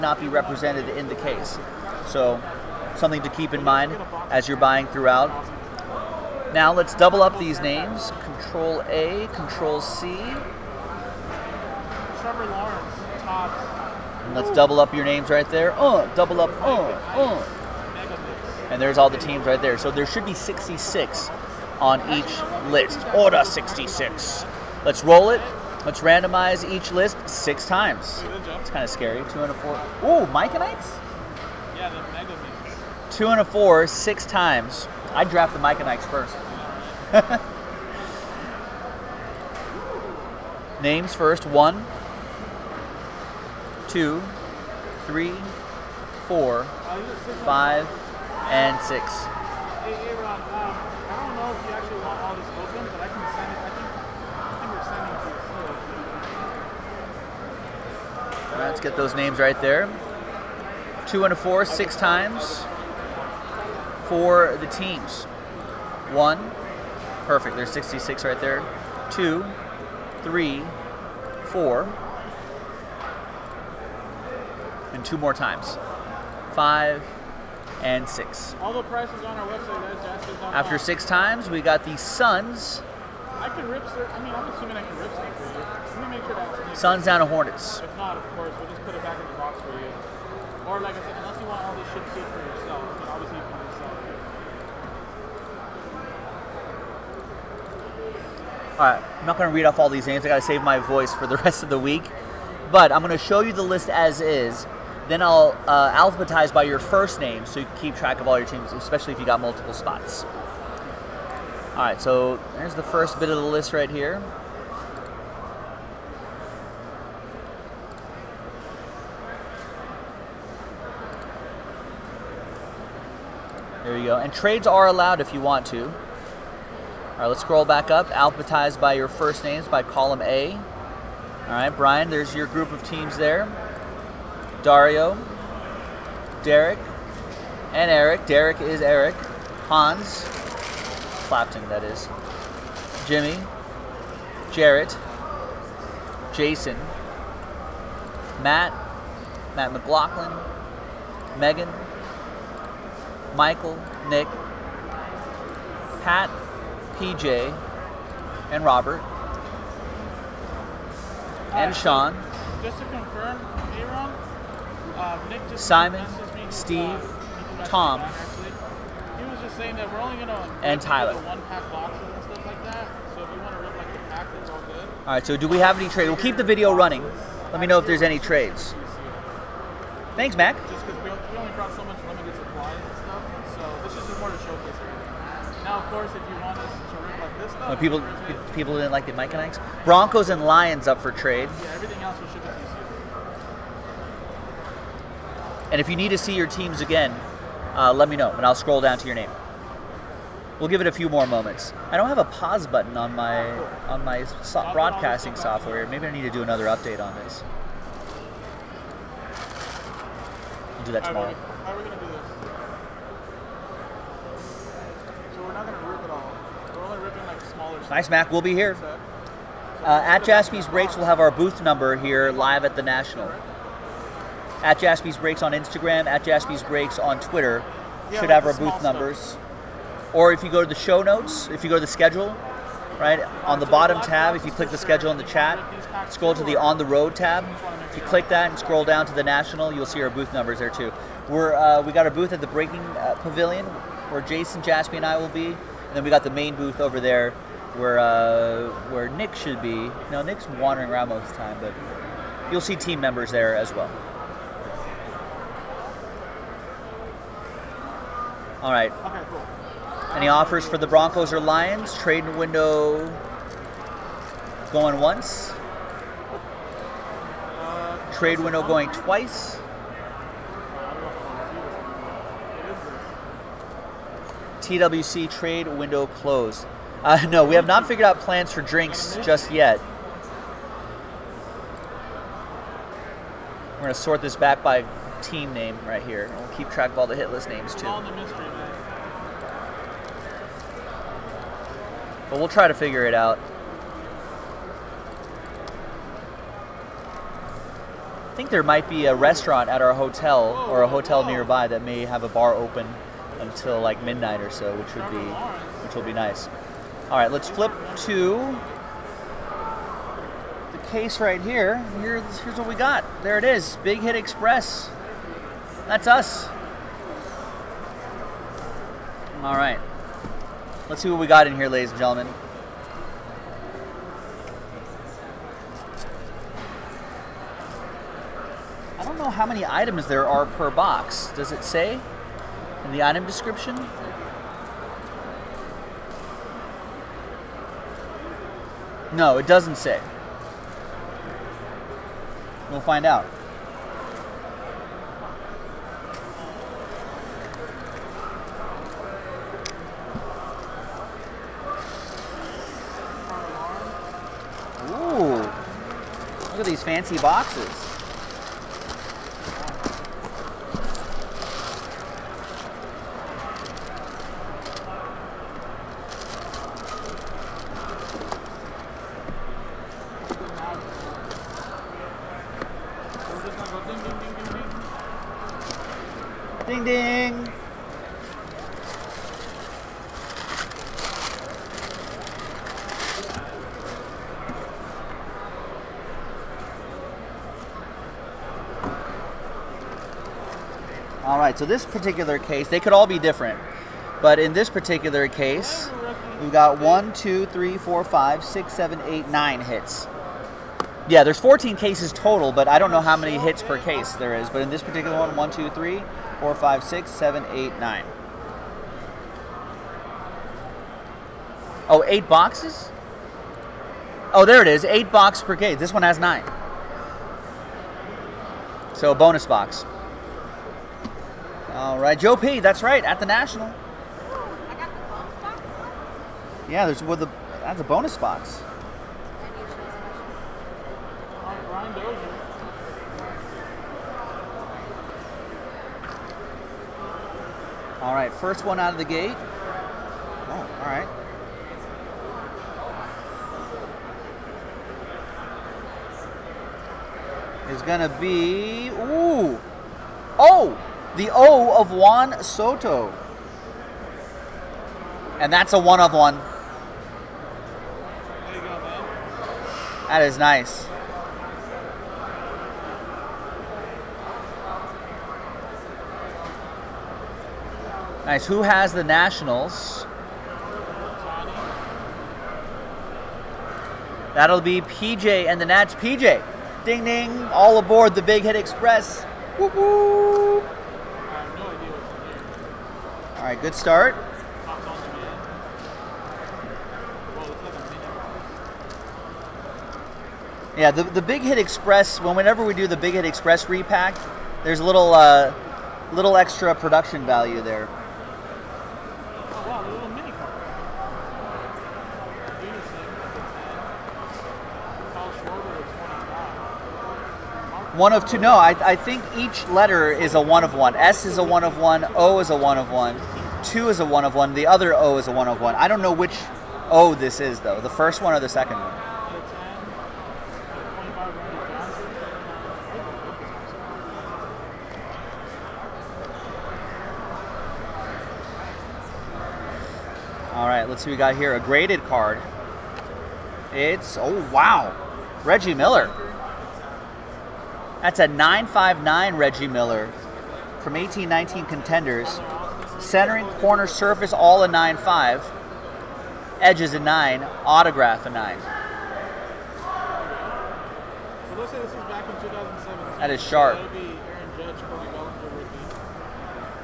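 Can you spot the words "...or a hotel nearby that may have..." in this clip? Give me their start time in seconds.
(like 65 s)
300 s.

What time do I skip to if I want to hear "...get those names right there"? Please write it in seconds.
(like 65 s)
58 s.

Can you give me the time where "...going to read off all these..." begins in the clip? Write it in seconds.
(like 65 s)
99 s.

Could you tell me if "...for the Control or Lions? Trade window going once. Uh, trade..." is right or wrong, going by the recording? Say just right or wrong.
wrong.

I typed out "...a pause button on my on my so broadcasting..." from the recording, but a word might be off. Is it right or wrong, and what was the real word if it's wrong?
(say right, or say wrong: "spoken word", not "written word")
right.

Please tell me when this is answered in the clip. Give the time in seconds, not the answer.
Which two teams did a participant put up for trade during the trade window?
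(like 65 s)
189 s.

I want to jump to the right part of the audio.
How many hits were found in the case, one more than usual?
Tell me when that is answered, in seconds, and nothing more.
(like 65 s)
399 s.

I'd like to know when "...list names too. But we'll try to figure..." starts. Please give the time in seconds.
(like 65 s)
287 s.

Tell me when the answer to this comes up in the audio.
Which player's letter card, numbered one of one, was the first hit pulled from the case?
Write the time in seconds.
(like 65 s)
451 s.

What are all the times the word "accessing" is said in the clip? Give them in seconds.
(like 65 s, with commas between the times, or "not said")
not said.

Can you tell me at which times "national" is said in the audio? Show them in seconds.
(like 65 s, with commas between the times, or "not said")
222 s, 239 s, 423 s, 469 s.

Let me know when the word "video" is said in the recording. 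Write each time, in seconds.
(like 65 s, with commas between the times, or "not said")
176 s.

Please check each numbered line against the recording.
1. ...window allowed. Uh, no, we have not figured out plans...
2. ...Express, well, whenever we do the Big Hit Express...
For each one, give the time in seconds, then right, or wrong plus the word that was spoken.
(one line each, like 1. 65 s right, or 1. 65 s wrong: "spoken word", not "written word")
1. 275 s wrong: "closed", not "allowed"
2. 491 s right.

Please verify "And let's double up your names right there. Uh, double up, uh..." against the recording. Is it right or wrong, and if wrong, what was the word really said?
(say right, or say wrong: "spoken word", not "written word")
right.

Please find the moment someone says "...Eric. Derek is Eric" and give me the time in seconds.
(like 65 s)
137 s.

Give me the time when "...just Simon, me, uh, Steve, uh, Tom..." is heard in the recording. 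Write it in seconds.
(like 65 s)
165 s.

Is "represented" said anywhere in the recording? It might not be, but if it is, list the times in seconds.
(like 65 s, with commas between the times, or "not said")
0 s.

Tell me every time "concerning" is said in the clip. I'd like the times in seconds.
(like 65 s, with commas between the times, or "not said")
not said.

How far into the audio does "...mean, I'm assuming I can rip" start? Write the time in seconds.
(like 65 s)
84 s.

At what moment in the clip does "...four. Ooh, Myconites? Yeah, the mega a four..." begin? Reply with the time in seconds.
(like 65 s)
29 s.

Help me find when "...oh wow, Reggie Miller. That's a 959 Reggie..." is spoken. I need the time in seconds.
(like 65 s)
534 s.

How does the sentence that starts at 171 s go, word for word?
One pack boxes and stuff like that.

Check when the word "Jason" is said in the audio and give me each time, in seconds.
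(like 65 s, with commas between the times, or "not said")
146 s, 244 s.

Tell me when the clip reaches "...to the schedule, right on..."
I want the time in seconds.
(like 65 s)
231 s.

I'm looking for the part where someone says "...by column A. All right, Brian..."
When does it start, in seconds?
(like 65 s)
129 s.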